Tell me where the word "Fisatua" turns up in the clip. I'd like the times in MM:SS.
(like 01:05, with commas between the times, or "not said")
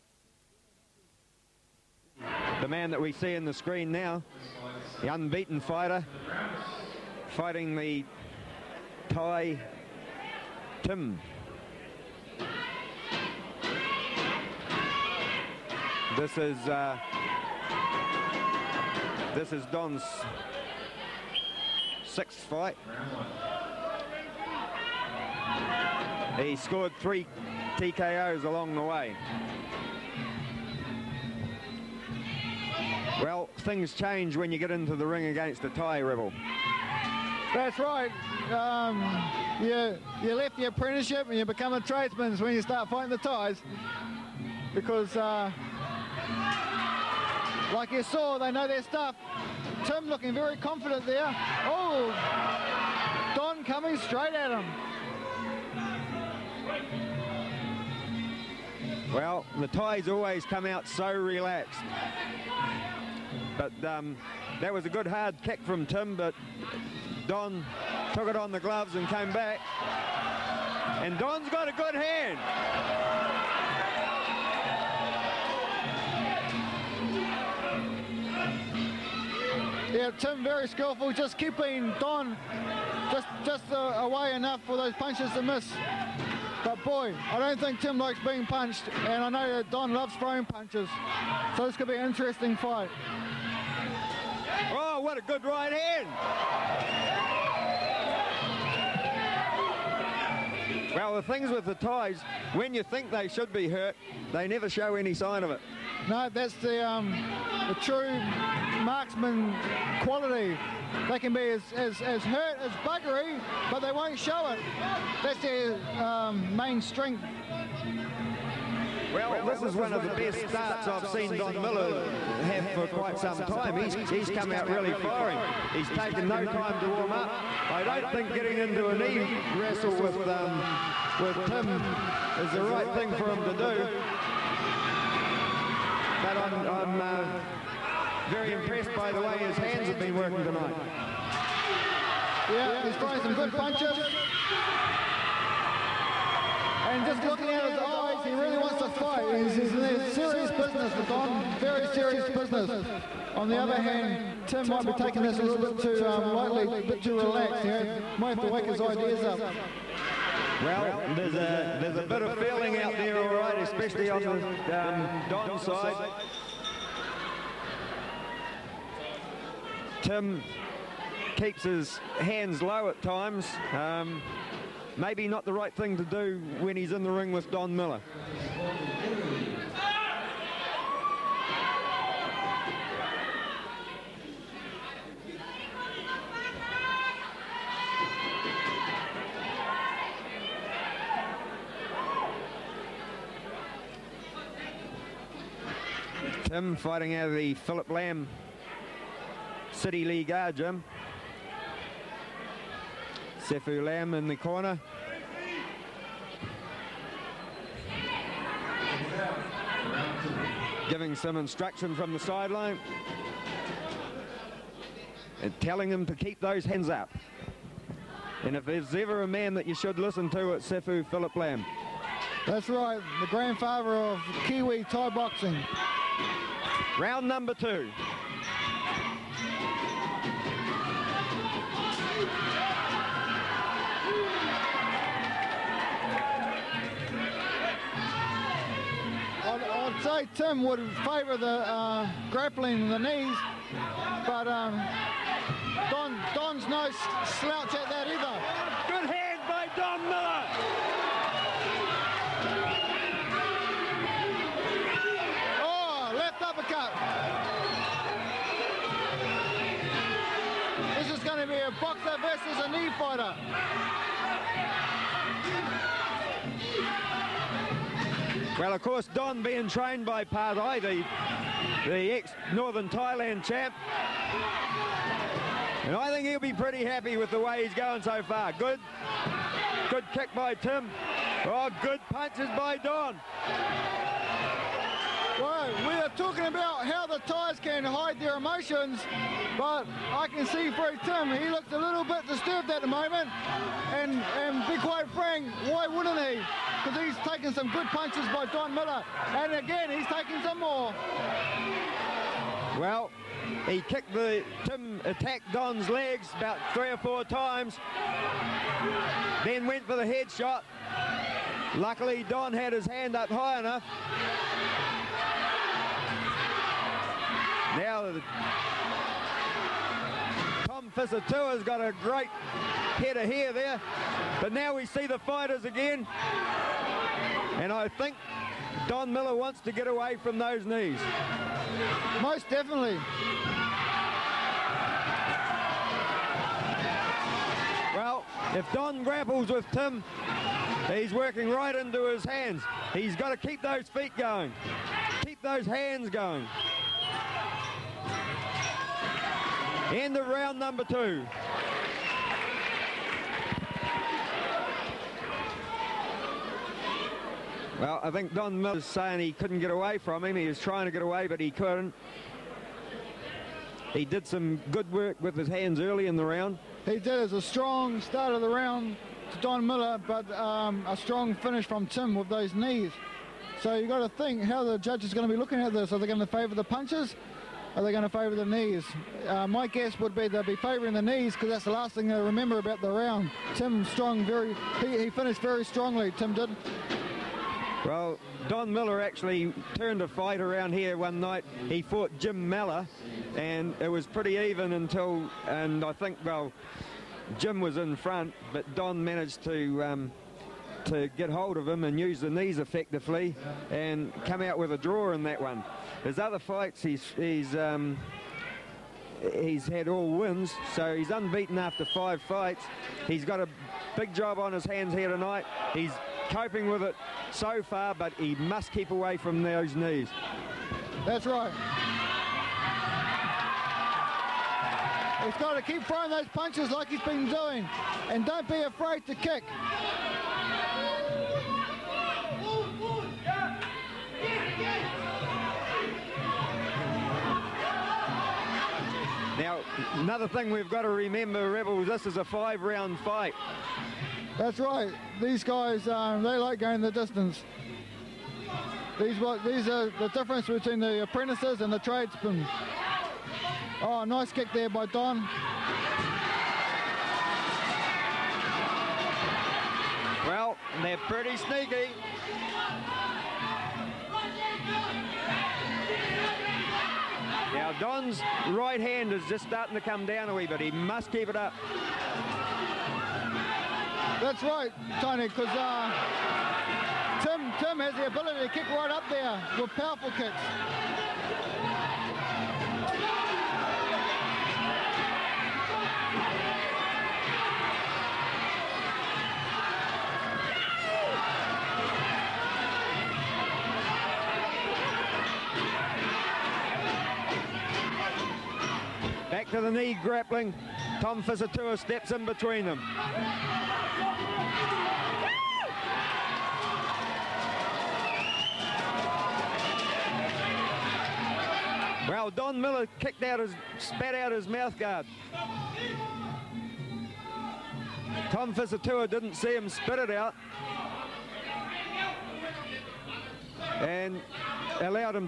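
08:21, 08:38.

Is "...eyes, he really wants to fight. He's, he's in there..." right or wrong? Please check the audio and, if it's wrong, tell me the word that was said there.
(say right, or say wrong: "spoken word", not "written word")
right.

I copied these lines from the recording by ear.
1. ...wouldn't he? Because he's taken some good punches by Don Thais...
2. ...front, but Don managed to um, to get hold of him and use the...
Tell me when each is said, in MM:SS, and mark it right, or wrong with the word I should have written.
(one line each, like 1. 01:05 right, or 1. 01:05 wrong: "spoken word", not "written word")
1. 04:55 wrong: "Millar", not "Thais"
2. 06:37 right.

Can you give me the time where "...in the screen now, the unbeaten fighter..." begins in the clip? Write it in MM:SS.
00:03.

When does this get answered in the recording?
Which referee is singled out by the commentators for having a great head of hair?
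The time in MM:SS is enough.
05:20.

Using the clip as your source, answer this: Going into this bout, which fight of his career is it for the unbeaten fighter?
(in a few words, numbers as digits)
6th.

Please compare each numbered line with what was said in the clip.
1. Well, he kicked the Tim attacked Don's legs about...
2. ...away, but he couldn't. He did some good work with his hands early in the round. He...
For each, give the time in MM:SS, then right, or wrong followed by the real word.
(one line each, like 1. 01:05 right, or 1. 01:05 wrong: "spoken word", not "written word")
1. 05:02 right
2. 06:01 right.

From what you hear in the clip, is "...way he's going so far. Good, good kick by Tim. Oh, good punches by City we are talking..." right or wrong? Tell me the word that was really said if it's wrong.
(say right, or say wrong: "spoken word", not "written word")
wrong: "Don", not "City".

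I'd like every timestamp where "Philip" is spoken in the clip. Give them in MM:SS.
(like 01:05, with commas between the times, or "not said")
03:17, 03:41.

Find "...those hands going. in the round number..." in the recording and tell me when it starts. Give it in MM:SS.
05:45.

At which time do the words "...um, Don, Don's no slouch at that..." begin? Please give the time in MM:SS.
04:04.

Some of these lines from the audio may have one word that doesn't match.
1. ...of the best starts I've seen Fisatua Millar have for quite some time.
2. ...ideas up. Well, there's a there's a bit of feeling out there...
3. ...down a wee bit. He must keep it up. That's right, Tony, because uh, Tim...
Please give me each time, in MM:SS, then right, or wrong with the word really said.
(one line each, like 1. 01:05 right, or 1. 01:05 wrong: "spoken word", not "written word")
1. 01:59 wrong: "Don", not "Fisatua"
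2. 02:38 right
3. 07:50 right.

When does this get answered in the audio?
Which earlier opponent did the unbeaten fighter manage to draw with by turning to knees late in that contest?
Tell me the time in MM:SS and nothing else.
06:32.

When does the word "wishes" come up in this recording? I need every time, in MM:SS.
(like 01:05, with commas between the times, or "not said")
not said.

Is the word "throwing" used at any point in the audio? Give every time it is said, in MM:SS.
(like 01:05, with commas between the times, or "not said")
01:30, 02:22, 07:05.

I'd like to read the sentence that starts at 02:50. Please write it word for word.
Tim keeps his hands low at times.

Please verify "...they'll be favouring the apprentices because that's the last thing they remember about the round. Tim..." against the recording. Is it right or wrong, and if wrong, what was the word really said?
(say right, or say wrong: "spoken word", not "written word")
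wrong: "knees", not "apprentices".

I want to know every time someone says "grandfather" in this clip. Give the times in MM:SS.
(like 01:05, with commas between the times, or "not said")
03:43.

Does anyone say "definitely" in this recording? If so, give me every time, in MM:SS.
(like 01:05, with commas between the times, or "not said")
05:32.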